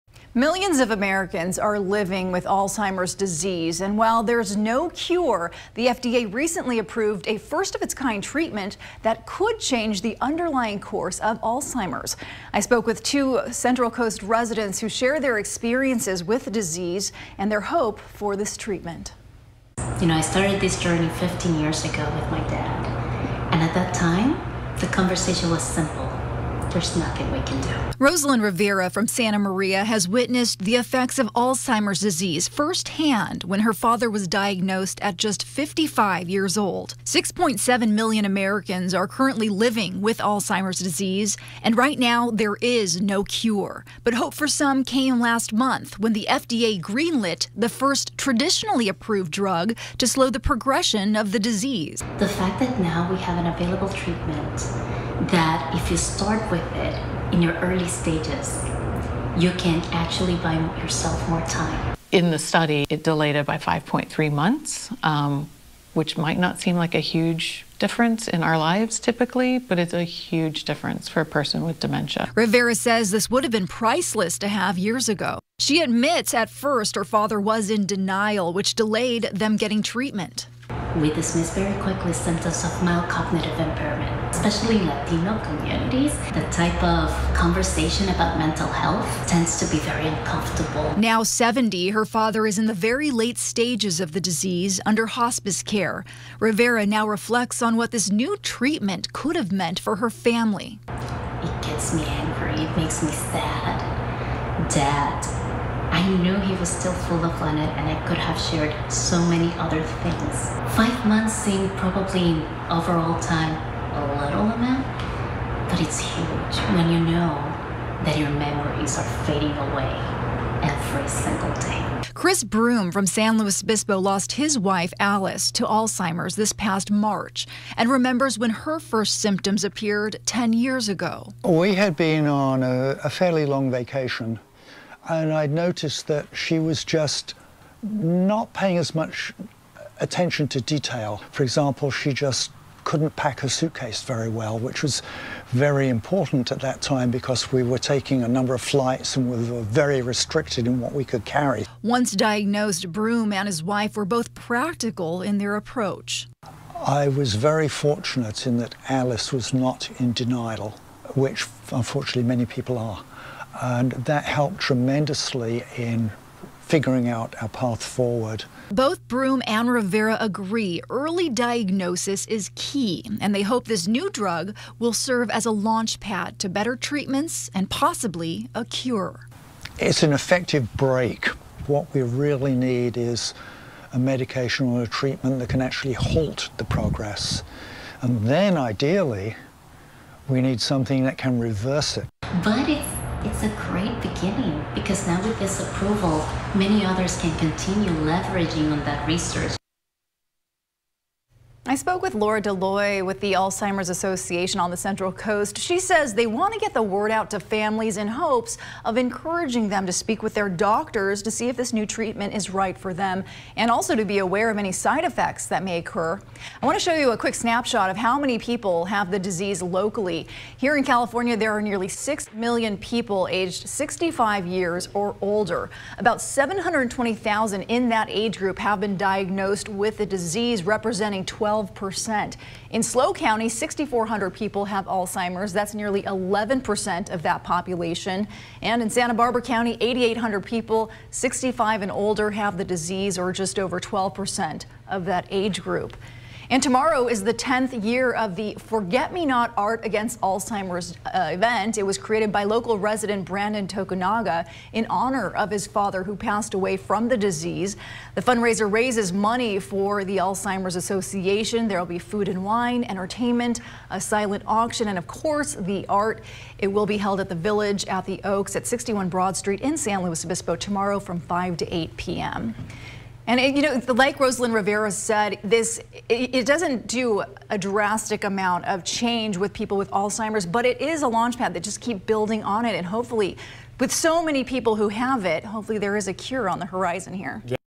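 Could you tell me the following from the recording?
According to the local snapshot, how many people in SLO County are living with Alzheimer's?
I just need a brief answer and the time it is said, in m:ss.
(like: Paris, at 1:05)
6,400, at 3:53.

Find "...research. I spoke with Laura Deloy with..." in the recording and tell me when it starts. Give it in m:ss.
3:19.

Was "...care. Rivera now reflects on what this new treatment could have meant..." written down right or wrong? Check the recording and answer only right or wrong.
right.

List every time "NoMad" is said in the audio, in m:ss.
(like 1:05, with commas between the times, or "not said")
not said.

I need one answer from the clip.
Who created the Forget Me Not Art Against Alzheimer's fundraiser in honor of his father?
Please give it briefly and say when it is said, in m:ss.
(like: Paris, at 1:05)
Brandon Tokunaga, at 4:13.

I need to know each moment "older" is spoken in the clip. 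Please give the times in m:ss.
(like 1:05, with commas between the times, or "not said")
3:45, 4:01.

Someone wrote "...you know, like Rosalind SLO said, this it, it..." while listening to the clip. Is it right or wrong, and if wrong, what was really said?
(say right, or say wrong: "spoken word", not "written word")
wrong: "Rivera", not "SLO".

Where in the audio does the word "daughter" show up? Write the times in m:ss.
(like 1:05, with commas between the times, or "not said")
not said.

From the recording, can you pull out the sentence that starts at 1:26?
The type of conversation about mental health tends to be very uncomfortable.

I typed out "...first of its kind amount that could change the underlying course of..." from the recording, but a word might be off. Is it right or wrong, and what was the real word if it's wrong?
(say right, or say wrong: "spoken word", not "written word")
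wrong: "treatment", not "amount".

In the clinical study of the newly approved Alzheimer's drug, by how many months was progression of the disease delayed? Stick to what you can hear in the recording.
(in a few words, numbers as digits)
5.3 months.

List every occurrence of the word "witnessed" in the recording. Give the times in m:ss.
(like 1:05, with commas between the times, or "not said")
0:30.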